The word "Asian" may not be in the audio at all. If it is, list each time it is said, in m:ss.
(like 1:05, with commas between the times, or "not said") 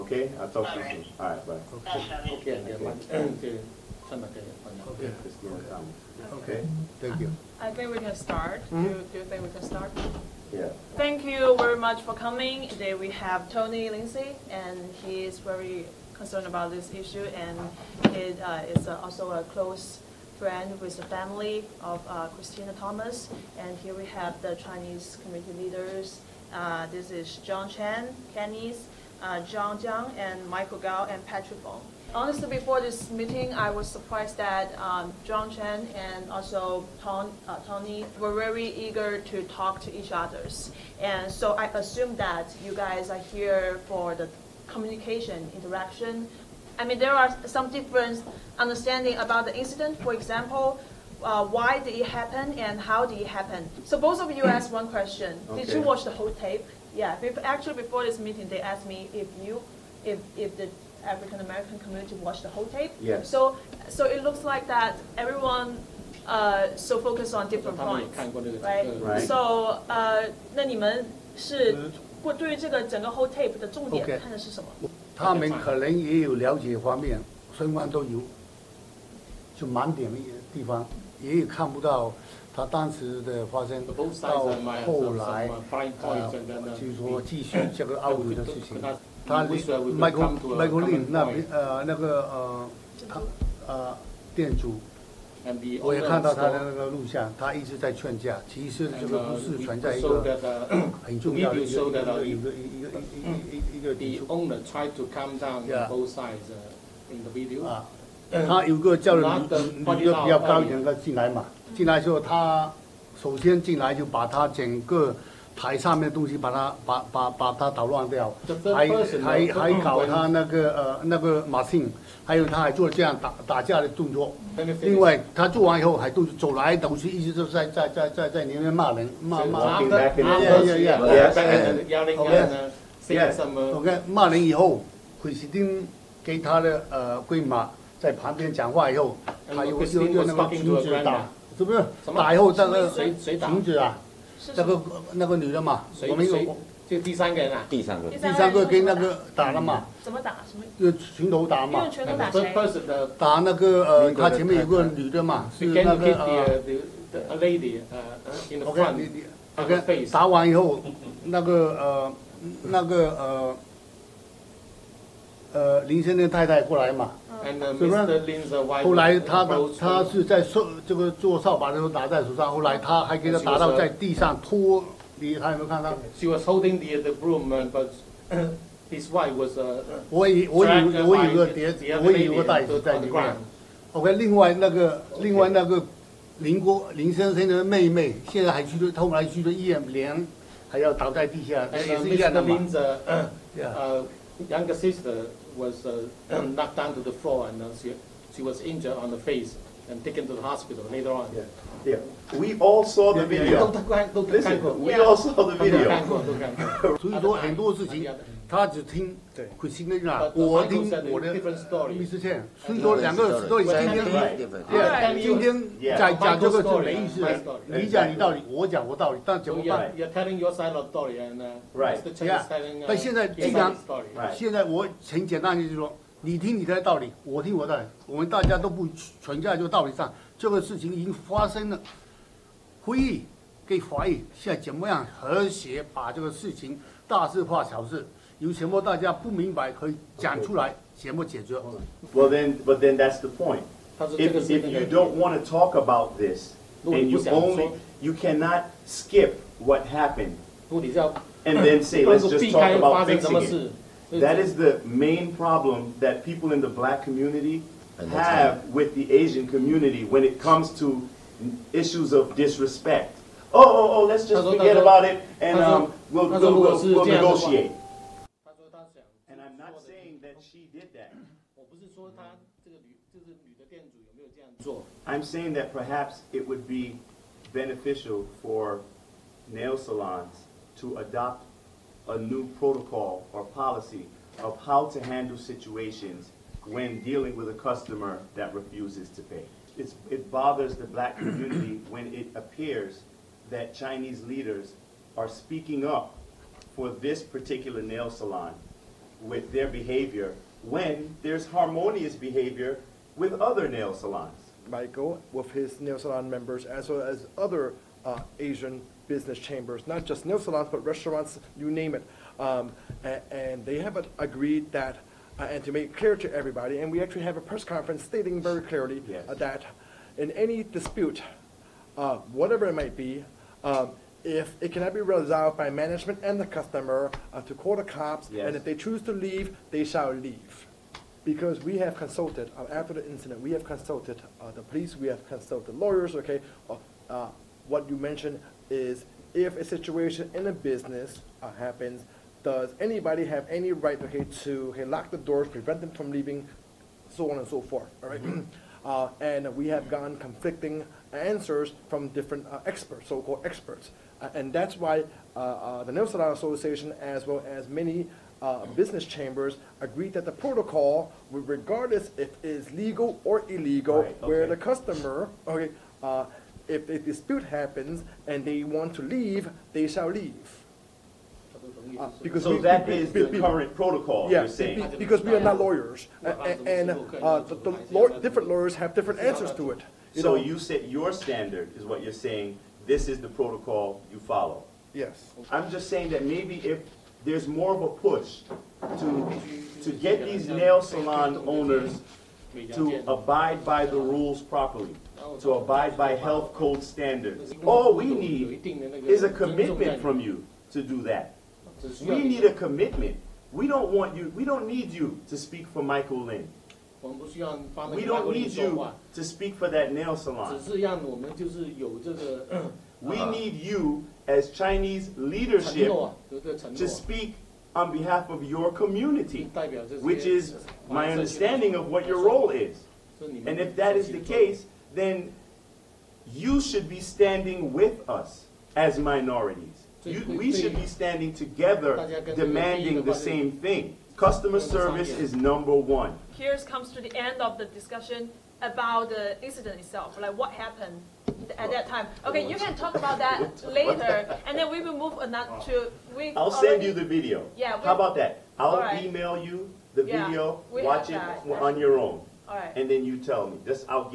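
4:19, 5:08.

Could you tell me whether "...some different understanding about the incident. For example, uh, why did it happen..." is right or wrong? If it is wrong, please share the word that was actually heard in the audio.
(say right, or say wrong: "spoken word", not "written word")
right.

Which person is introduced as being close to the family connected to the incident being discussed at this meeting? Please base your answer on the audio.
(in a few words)
Tony Lindsay.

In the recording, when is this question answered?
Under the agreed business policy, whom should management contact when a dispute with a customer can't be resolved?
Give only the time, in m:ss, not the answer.
5:27.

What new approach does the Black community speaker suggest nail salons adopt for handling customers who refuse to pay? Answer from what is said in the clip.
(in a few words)
a new protocol.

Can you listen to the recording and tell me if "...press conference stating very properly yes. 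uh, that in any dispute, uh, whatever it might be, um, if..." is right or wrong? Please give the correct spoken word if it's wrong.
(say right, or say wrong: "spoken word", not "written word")
wrong: "clearly", not "properly".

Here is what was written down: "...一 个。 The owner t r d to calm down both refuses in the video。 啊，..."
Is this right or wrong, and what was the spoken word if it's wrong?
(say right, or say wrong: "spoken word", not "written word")
wrong: "sides", not "refuses".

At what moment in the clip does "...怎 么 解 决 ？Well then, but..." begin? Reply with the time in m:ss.
4:00.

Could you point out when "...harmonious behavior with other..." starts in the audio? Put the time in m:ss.
5:01.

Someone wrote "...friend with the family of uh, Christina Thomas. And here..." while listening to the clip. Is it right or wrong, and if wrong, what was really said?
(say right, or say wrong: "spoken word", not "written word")
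right.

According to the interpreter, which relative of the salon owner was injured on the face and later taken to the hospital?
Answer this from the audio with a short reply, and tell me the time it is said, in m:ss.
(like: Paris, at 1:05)
younger sister, at 3:14.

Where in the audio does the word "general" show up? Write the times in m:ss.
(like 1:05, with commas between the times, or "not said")
not said.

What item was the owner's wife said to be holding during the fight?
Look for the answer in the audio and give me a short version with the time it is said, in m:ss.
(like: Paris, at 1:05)
the broom, at 2:57.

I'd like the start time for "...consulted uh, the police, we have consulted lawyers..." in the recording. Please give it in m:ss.
5:33.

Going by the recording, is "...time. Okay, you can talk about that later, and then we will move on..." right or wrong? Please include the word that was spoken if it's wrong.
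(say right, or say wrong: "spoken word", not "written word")
right.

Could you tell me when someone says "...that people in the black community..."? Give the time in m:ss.
4:16.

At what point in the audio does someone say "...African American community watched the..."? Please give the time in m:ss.
1:01.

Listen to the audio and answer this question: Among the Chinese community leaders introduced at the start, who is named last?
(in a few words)
Patrick Wong.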